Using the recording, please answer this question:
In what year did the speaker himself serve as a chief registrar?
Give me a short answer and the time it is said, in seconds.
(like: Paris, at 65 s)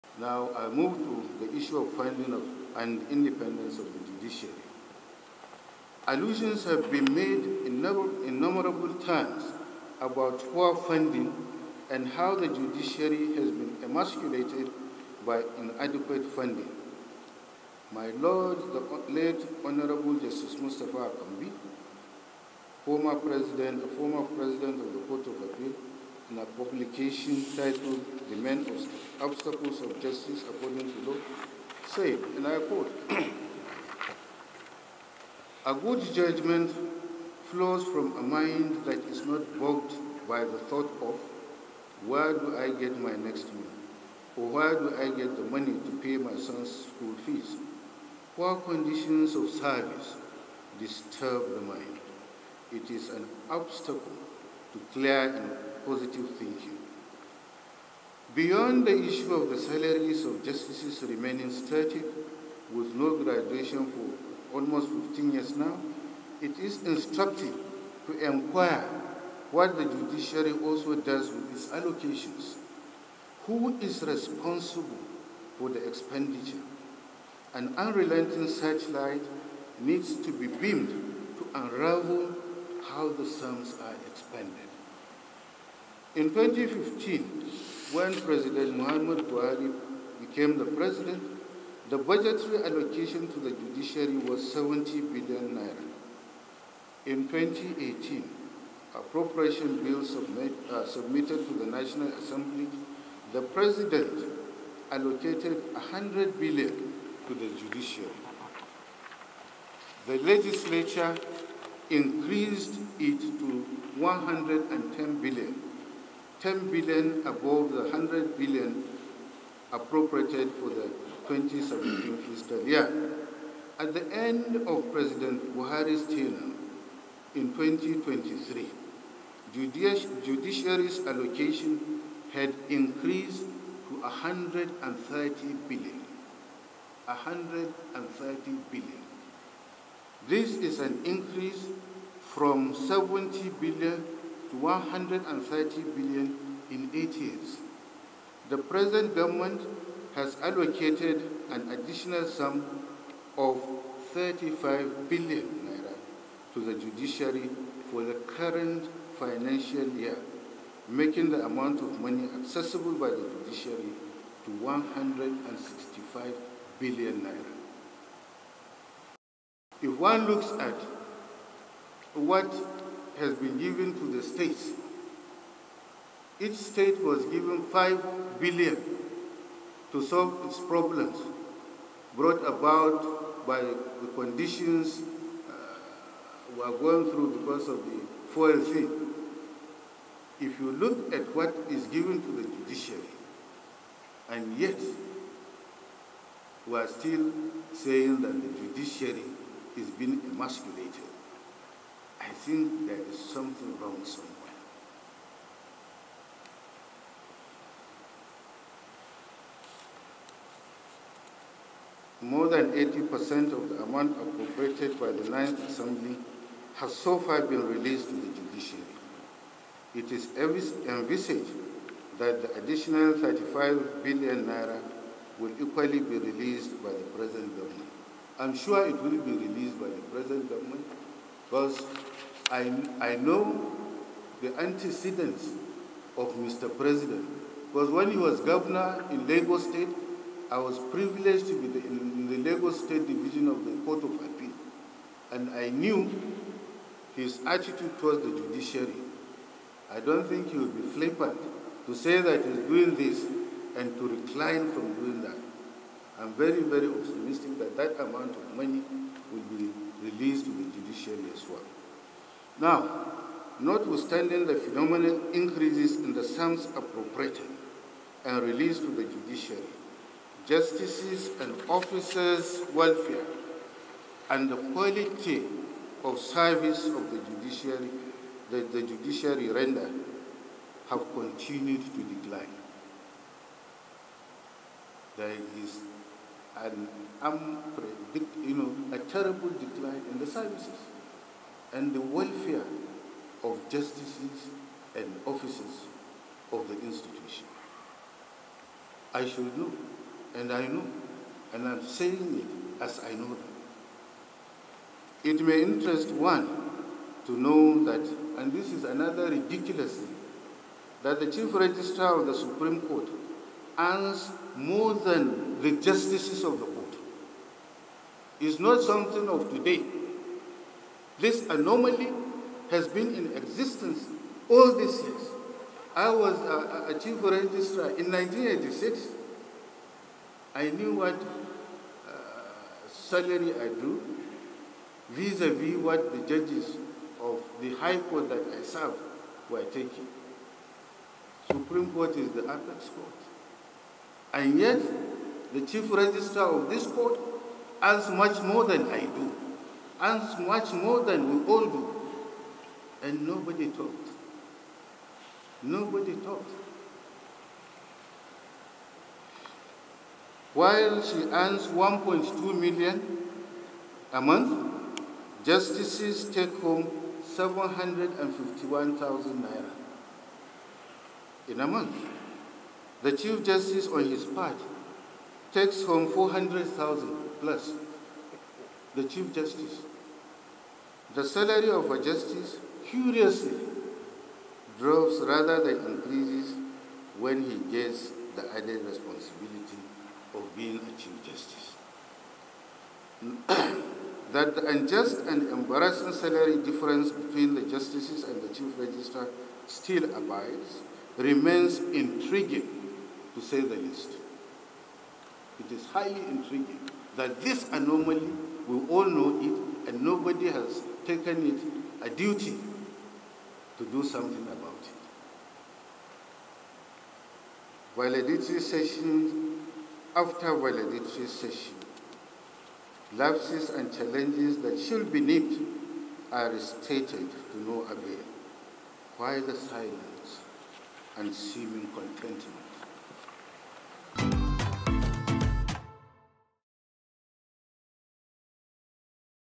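1986, at 328 s.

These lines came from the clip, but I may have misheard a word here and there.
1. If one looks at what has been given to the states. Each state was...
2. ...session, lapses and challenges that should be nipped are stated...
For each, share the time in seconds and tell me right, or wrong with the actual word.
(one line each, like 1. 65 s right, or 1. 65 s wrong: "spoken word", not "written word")
1. 169 s right
2. 421 s right.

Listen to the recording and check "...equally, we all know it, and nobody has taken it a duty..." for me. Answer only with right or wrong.
wrong.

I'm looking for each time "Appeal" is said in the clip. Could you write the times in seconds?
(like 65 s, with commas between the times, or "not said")
25 s, 244 s.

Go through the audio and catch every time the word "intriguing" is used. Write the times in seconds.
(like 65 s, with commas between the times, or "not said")
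401 s, 406 s.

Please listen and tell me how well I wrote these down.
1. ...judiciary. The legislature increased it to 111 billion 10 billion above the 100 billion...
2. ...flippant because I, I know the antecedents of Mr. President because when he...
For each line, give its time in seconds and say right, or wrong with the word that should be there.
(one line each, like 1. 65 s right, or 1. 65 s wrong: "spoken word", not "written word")
1. 107 s wrong: "110", not "111"
2. 230 s wrong: "government", not "flippant".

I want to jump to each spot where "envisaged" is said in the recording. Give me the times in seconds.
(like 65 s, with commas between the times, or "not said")
220 s.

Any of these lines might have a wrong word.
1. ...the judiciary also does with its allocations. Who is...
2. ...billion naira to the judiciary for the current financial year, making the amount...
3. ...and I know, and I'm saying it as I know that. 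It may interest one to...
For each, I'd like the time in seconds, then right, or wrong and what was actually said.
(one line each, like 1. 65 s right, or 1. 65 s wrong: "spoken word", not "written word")
1. 69 s right
2. 155 s right
3. 300 s right.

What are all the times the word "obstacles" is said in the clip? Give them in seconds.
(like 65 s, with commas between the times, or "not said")
29 s, 53 s.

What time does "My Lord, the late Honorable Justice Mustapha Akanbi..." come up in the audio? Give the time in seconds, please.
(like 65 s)
17 s.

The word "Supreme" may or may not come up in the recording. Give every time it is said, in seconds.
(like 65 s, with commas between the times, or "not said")
312 s, 341 s.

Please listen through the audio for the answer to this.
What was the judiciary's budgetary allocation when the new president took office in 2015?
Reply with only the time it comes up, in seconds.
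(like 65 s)
94 s.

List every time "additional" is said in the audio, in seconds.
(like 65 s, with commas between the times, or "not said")
151 s, 222 s.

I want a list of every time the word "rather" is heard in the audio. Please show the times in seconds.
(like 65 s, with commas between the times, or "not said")
385 s.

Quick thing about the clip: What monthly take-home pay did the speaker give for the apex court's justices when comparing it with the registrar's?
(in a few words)
751,000 naira.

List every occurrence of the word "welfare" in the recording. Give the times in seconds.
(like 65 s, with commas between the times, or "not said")
272 s, 292 s.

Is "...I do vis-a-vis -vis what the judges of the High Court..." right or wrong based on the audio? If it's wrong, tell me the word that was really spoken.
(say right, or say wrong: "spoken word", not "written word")
right.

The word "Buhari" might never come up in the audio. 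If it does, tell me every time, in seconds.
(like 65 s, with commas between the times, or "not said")
89 s, 125 s.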